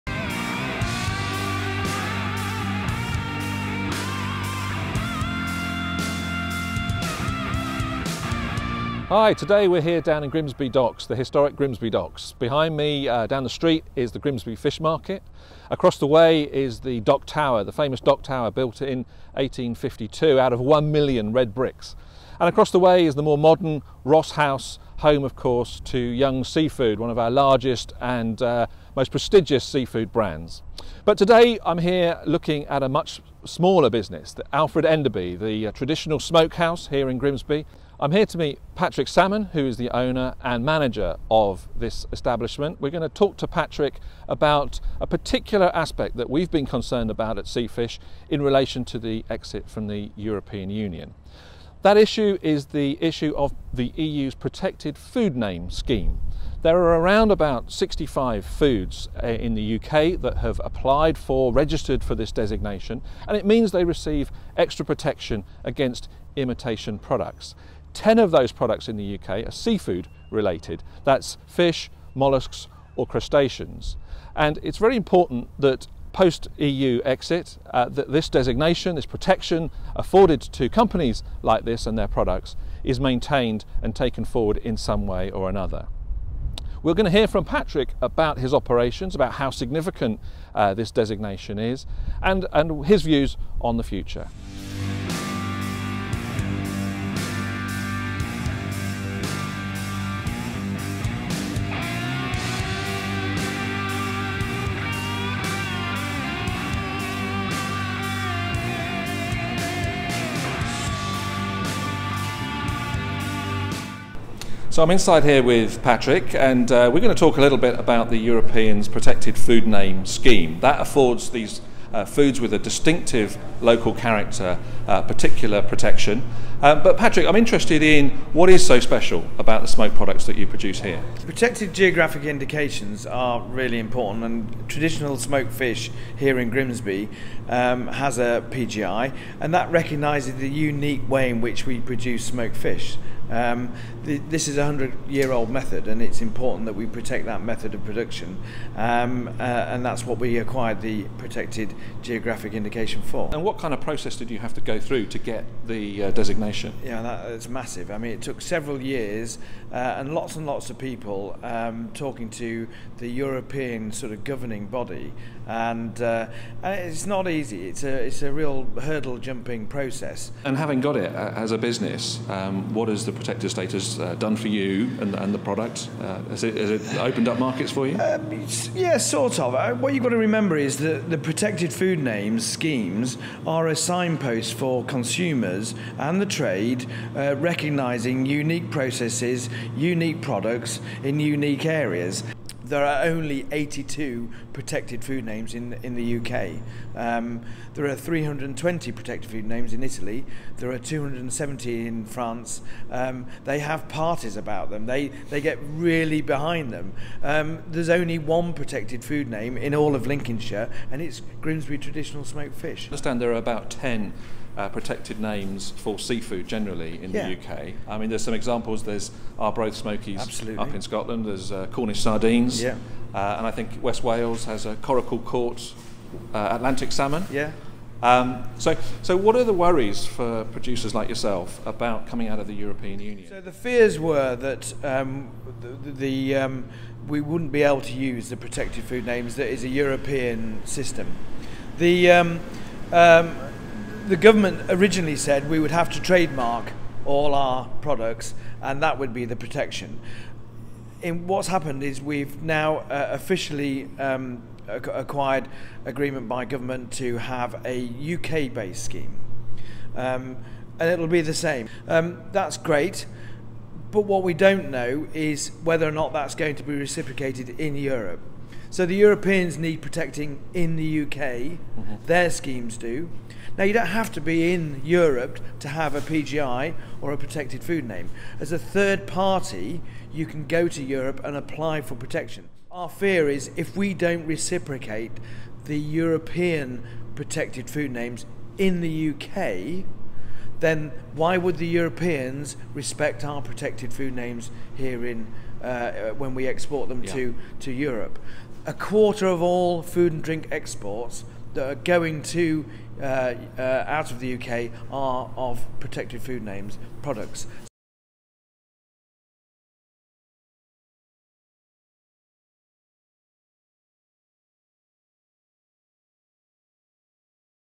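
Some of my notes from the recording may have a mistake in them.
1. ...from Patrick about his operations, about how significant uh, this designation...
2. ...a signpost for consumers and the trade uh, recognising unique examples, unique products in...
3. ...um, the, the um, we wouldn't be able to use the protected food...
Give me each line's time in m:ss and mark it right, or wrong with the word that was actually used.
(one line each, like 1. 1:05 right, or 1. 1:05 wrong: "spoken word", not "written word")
1. 1:27 right
2. 3:03 wrong: "processes", not "examples"
3. 3:54 right.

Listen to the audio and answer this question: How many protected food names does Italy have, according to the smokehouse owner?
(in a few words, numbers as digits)
320.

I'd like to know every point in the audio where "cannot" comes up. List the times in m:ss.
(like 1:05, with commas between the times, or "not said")
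not said.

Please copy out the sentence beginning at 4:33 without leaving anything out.
Now, you don't have to be in Europe to have a PGI or a protected food name.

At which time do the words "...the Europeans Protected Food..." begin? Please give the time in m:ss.
1:58.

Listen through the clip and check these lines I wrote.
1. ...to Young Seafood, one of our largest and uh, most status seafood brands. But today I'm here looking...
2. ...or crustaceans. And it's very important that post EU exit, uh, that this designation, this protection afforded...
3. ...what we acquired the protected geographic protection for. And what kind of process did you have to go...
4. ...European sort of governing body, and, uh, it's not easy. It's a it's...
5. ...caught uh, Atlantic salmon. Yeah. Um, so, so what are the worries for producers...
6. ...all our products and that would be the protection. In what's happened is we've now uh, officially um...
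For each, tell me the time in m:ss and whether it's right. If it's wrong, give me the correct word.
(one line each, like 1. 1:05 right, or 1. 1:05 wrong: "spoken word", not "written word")
1. 0:25 wrong: "prestigious", not "status"
2. 1:12 right
3. 2:30 wrong: "indication", not "protection"
4. 2:43 right
5. 3:45 right
6. 4:07 right.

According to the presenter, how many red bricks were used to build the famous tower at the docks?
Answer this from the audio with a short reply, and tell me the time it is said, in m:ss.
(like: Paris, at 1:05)
1 million, at 0:20.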